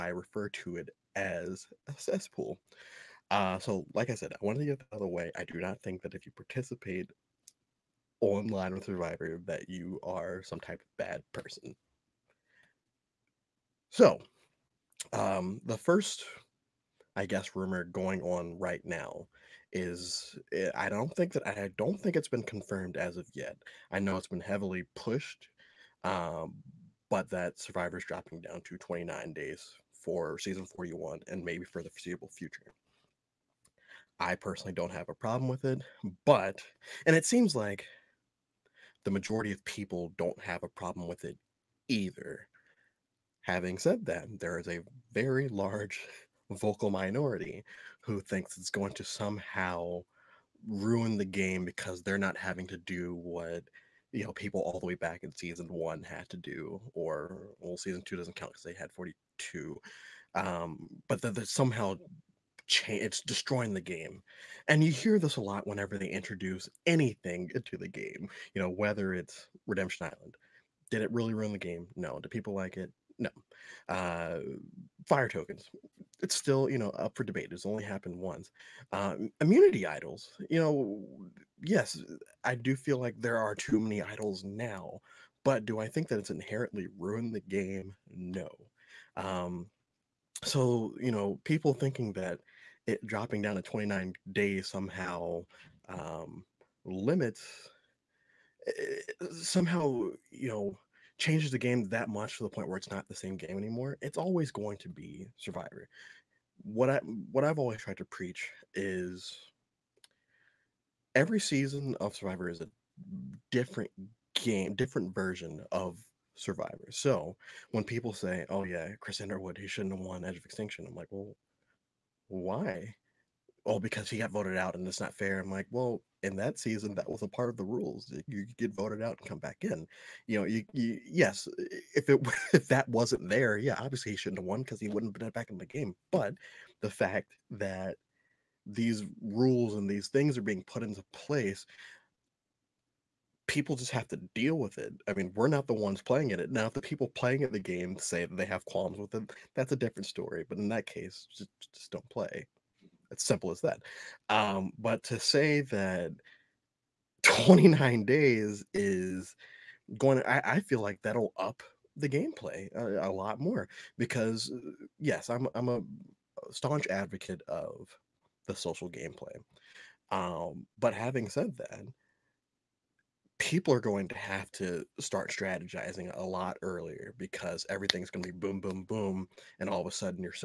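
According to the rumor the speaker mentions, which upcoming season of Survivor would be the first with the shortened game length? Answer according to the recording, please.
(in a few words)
Season 41.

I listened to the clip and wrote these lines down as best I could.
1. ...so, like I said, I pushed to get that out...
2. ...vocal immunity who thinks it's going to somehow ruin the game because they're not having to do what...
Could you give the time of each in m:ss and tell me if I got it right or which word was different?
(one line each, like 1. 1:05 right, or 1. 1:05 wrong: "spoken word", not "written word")
1. 0:03 wrong: "wanted", not "pushed"
2. 0:46 wrong: "minority", not "immunity".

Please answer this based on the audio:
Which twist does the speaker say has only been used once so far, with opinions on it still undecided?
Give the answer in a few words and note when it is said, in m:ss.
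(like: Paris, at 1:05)
Fire tokens, at 1:15.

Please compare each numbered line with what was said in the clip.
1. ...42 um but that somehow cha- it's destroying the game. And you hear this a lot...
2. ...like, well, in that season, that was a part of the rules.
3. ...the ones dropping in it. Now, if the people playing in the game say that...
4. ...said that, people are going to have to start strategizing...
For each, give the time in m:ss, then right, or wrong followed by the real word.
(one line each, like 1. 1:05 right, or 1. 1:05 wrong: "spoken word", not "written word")
1. 0:58 right
2. 2:05 right
3. 2:25 wrong: "playing", not "dropping"
4. 2:51 right.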